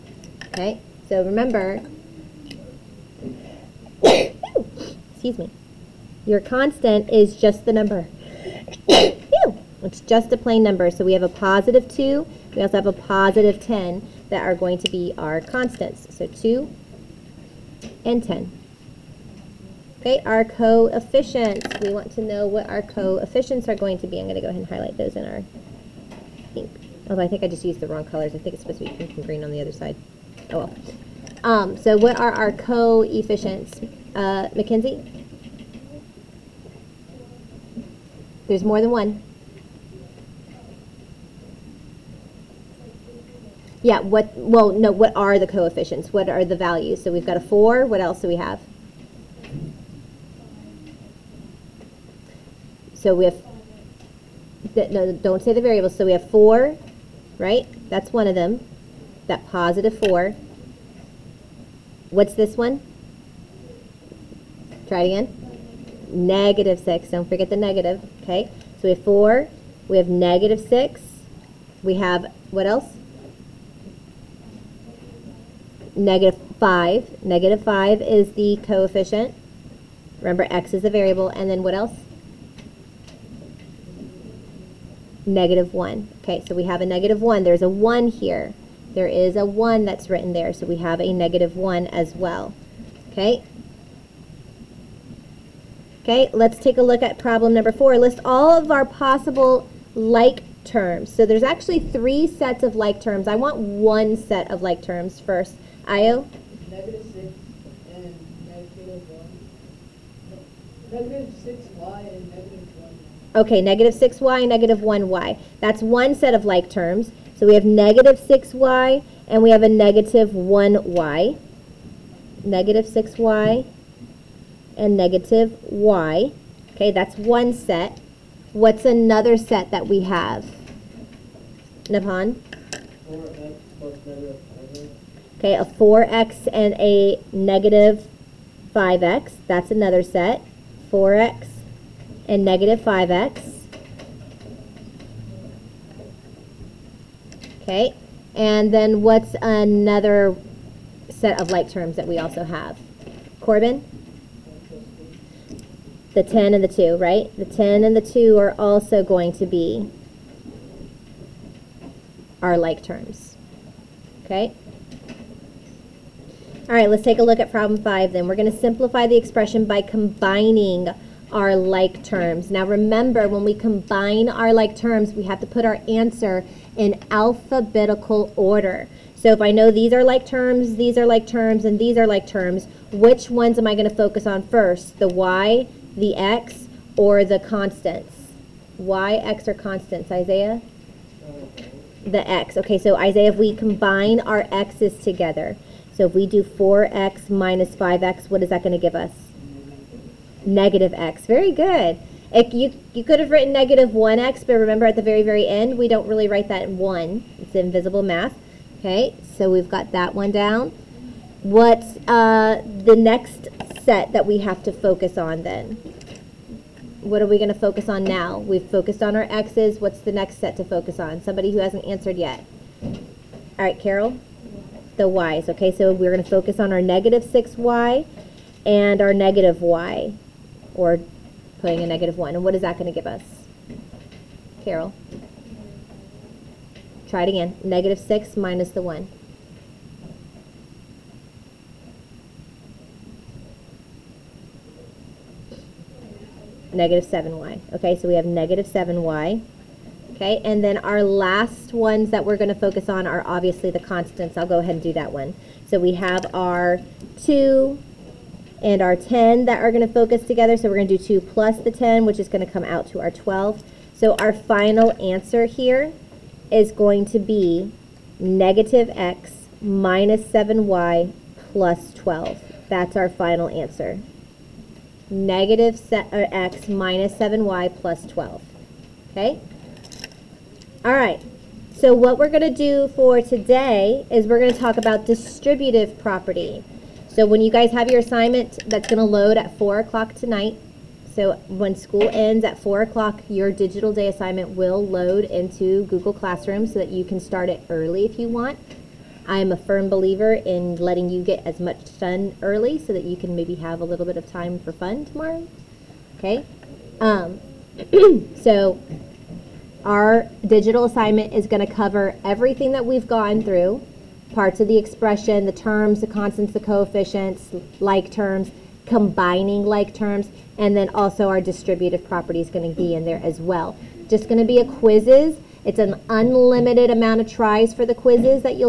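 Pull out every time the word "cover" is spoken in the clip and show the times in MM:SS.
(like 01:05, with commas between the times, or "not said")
05:11.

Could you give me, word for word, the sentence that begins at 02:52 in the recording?
Now remember, when we combine our like terms, we have to put our answer in alphabetical order.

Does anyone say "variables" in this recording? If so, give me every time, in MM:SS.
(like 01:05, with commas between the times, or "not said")
00:55, 01:20.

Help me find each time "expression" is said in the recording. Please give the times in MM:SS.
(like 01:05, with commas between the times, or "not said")
02:49, 05:14.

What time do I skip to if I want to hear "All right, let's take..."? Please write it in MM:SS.
02:46.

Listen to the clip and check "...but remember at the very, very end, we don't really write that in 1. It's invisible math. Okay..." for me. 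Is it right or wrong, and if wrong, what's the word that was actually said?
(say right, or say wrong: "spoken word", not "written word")
right.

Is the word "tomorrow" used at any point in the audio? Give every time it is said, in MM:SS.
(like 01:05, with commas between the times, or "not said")
05:05.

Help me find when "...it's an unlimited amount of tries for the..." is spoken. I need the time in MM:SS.
05:25.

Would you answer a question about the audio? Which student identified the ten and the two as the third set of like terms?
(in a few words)
Corbin.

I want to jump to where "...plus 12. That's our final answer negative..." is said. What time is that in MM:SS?
04:31.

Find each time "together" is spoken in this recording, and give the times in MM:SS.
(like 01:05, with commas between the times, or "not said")
03:15, 04:20.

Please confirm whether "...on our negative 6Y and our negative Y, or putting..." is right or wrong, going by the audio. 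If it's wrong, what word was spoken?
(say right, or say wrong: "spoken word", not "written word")
right.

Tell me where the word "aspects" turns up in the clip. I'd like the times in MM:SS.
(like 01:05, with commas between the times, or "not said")
not said.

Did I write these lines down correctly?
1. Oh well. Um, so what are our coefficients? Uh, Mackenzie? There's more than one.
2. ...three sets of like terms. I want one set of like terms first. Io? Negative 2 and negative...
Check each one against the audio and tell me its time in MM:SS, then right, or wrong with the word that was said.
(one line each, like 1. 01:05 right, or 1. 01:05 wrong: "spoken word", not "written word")
1. 00:30 right
2. 01:41 wrong: "6", not "2".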